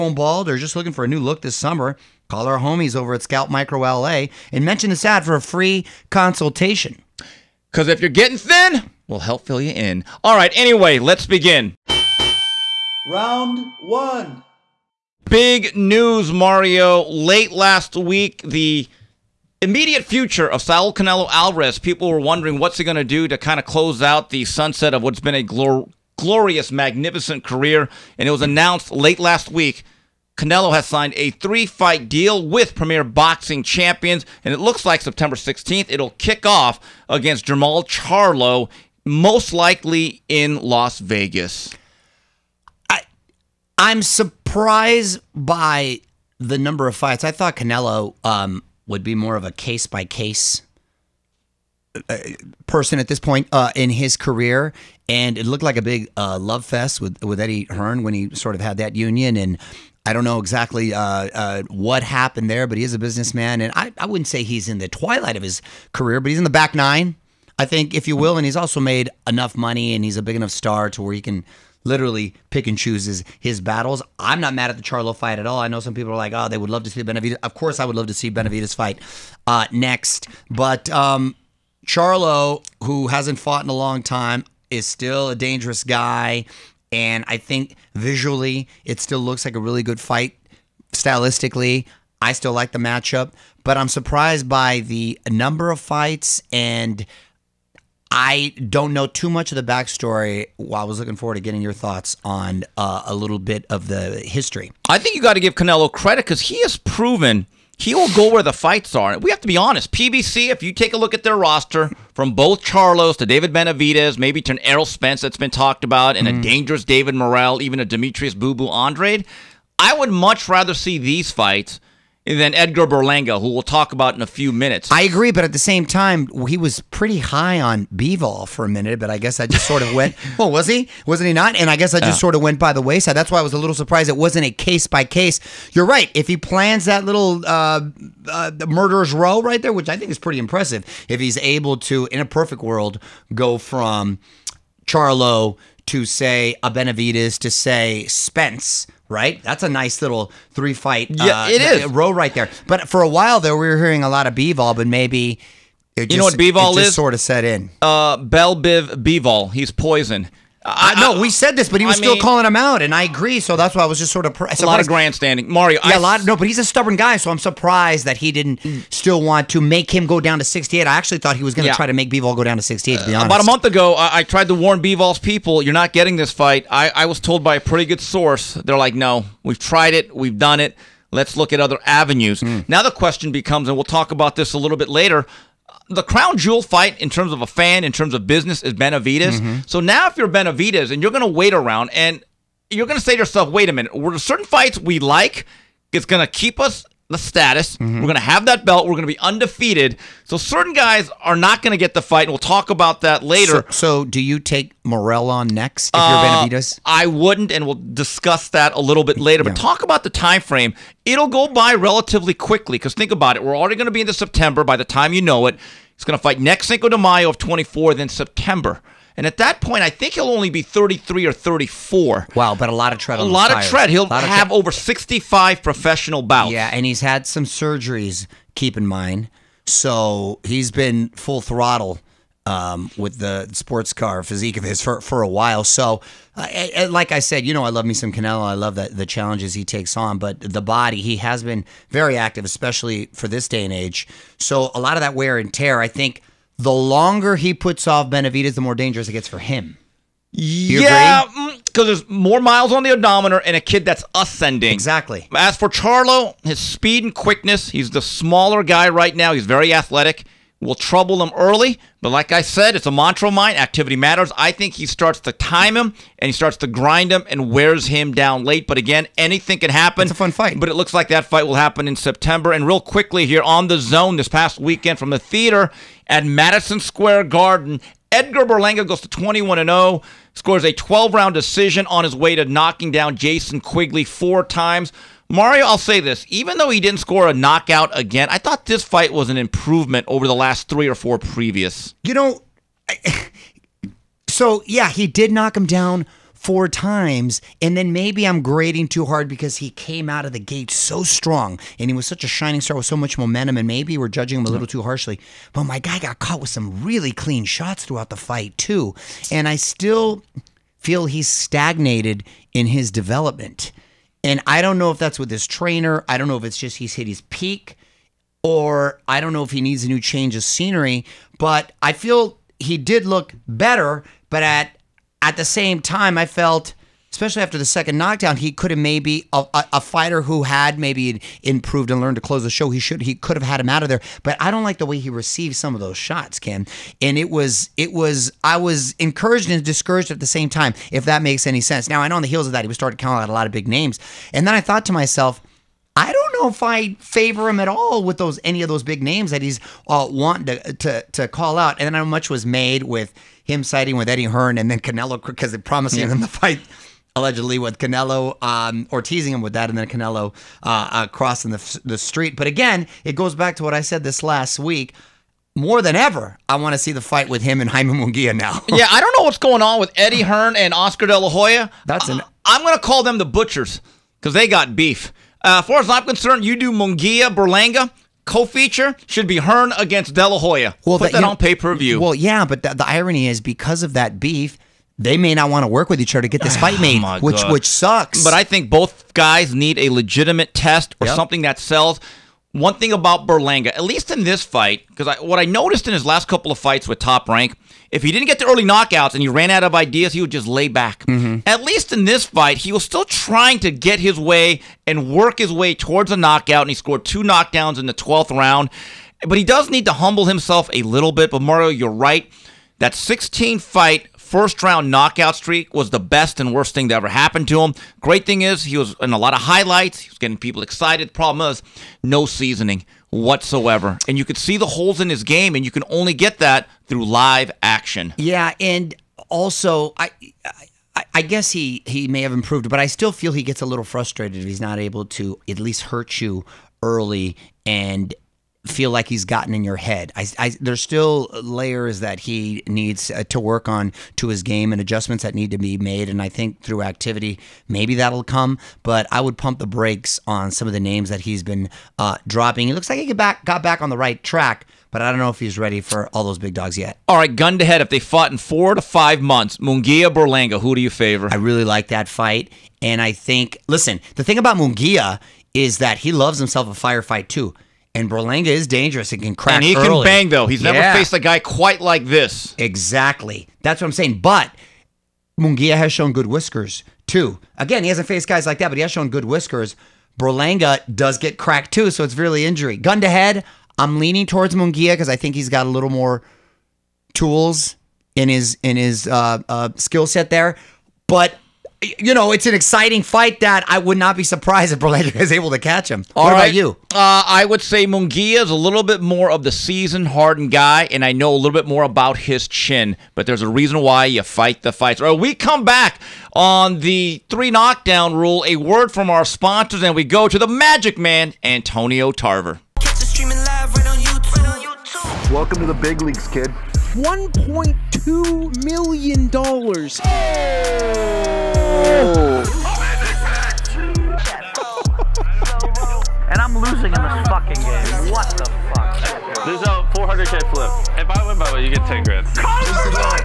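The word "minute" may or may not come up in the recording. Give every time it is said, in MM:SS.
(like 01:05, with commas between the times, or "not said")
02:04, 02:08, 03:13.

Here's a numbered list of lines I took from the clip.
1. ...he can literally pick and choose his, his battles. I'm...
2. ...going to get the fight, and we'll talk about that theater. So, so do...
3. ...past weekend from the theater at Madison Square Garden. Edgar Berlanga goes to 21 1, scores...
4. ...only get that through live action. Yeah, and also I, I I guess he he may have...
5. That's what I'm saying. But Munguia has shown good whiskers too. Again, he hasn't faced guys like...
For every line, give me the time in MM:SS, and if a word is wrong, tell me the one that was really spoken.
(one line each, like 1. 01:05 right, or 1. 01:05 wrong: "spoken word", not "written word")
1. 01:11 right
2. 03:21 wrong: "later", not "theater"
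3. 04:34 wrong: "0", not "1"
4. 07:05 right
5. 07:53 right.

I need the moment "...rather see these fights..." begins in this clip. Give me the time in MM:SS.
02:00.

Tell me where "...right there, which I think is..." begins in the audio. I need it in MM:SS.
02:19.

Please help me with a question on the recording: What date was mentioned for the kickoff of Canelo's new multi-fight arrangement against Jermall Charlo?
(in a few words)
September 16th.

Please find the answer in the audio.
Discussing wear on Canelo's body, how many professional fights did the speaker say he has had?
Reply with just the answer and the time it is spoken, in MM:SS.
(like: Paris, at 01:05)
65, at 03:44.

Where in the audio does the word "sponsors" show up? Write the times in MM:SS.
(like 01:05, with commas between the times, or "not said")
08:29.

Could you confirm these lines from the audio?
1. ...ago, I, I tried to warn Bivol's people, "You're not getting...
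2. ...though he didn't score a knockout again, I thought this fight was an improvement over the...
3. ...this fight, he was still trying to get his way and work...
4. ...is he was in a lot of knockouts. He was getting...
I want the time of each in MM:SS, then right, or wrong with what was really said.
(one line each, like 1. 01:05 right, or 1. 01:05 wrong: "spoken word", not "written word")
1. 02:53 right
2. 04:46 right
3. 06:42 right
4. 06:58 wrong: "highlights", not "knockouts".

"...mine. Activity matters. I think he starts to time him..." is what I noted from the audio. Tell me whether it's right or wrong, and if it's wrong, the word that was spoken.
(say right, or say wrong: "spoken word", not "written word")
right.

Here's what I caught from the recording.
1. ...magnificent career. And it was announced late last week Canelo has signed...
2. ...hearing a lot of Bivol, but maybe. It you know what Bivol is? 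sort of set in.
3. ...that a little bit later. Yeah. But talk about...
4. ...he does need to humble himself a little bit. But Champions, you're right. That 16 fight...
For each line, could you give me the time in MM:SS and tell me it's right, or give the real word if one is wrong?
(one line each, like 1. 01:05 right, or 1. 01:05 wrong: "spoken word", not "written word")
1. 00:26 right
2. 02:33 right
3. 03:28 right
4. 06:49 wrong: "Mario", not "Champions".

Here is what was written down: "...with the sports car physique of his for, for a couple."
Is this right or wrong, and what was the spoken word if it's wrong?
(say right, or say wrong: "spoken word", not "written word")
wrong: "while", not "couple".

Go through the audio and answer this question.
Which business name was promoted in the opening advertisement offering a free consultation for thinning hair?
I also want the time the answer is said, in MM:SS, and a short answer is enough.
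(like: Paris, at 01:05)
Scalp Micro LA, at 00:03.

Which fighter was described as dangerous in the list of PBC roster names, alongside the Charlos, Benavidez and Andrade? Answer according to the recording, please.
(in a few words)
David Morrell.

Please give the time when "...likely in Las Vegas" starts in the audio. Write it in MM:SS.
00:39.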